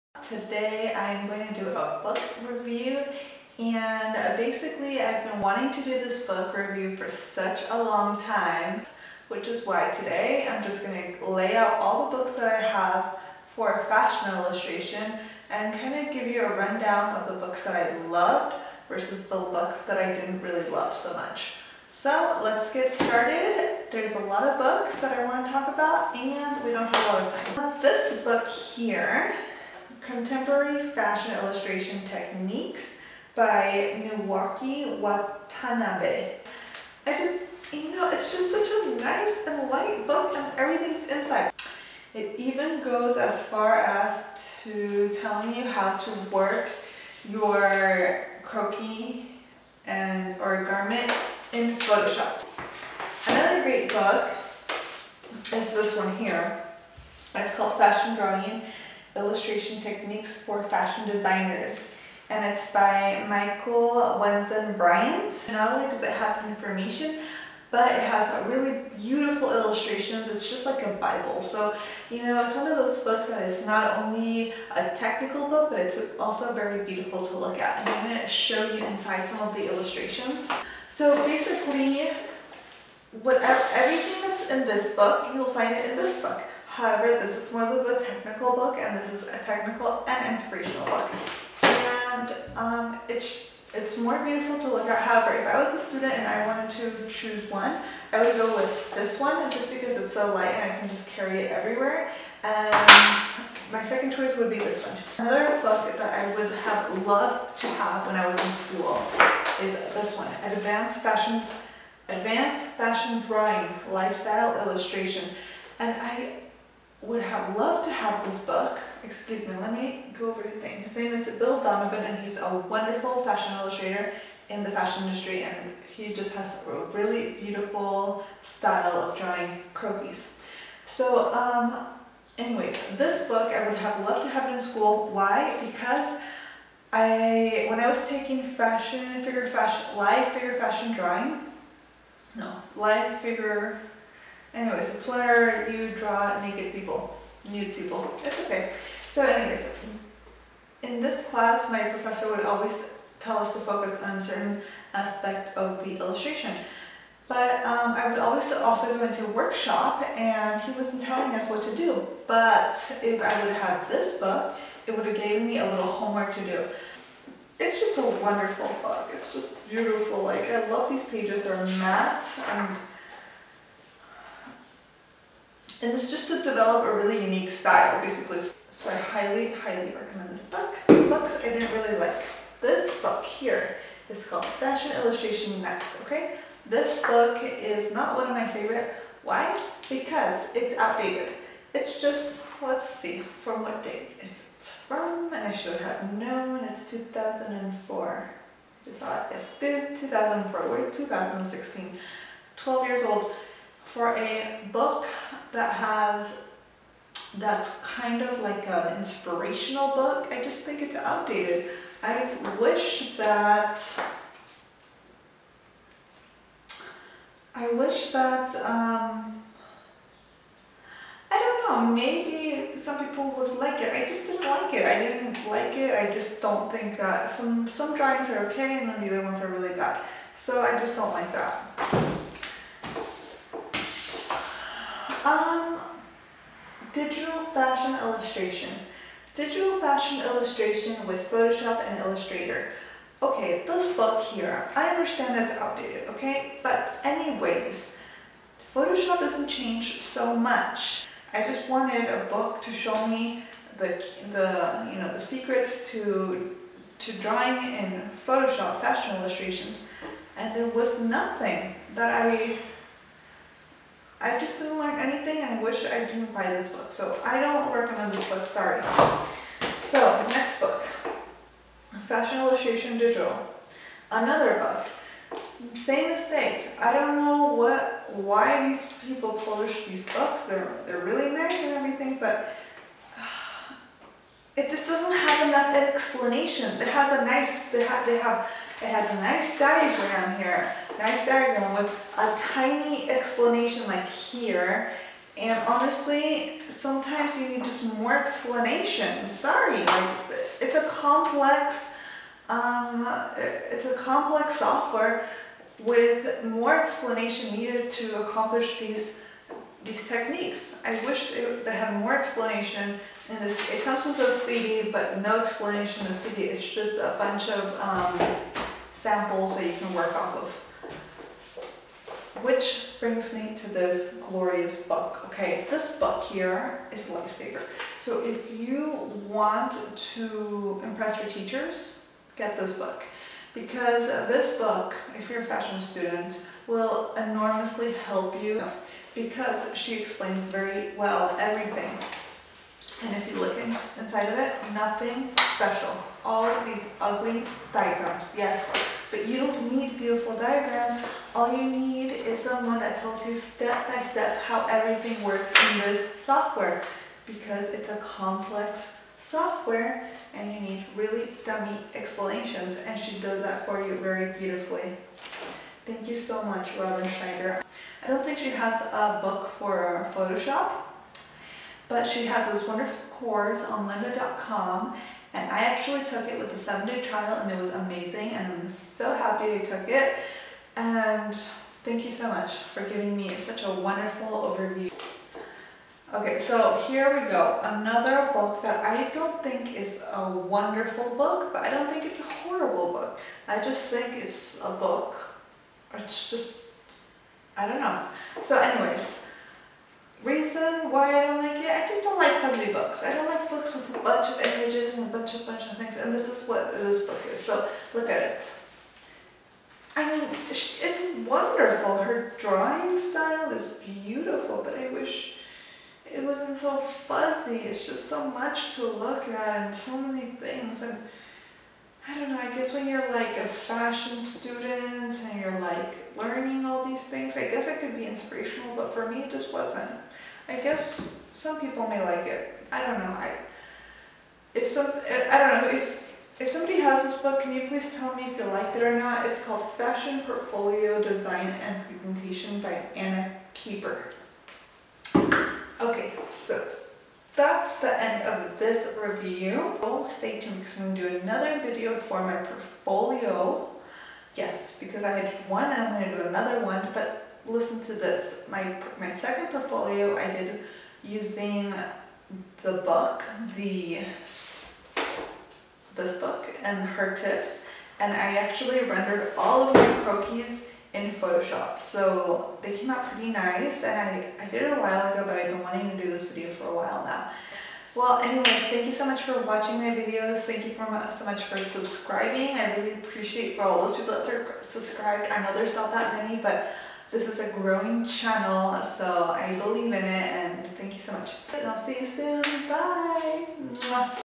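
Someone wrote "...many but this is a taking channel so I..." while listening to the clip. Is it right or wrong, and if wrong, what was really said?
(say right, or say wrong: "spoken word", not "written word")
wrong: "growing", not "taking".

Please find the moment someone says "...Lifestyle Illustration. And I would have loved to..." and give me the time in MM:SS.
01:53.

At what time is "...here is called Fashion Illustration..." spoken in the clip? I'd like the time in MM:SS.
03:03.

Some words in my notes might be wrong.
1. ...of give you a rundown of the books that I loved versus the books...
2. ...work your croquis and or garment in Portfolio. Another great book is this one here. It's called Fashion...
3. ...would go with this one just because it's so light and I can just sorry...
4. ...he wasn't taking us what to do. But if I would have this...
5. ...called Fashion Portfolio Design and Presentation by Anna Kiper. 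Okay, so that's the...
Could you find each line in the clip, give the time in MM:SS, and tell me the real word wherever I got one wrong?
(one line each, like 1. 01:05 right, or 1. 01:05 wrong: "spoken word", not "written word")
1. 00:16 right
2. 00:46 wrong: "Photoshop", not "Portfolio"
3. 01:38 wrong: "carry", not "sorry"
4. 02:40 wrong: "telling", not "taking"
5. 07:19 right.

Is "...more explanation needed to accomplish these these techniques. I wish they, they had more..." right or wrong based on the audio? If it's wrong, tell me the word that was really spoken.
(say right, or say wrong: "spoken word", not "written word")
right.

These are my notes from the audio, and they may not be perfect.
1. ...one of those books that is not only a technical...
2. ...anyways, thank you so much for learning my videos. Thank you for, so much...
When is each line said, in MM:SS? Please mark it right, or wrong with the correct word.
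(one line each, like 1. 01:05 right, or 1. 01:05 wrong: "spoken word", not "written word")
1. 01:12 right
2. 07:58 wrong: "watching", not "learning".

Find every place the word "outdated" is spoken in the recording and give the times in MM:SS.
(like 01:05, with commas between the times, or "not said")
03:10, 03:30, 04:05.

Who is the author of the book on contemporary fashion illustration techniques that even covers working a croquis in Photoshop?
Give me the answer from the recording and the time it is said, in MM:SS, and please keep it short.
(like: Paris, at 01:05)
Naoki Watanabe, at 00:34.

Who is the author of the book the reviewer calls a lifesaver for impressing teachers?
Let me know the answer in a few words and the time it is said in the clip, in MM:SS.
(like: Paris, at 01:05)
Robin Schneider, at 06:06.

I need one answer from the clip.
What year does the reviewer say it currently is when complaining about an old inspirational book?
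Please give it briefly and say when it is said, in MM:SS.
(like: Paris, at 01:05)
2016, at 03:20.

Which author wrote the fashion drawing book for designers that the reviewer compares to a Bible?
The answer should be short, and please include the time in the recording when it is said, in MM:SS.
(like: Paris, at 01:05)
Michael Wesen Bryant, at 01:03.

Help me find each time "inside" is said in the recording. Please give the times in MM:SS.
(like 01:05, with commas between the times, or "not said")
00:41, 01:18, 05:43.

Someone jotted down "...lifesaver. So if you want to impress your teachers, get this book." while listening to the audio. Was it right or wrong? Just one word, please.
right.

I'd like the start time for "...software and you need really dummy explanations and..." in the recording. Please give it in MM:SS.
05:59.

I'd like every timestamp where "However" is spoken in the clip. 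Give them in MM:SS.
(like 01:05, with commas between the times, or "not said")
01:26, 01:34.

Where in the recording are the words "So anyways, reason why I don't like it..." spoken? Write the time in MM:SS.
06:38.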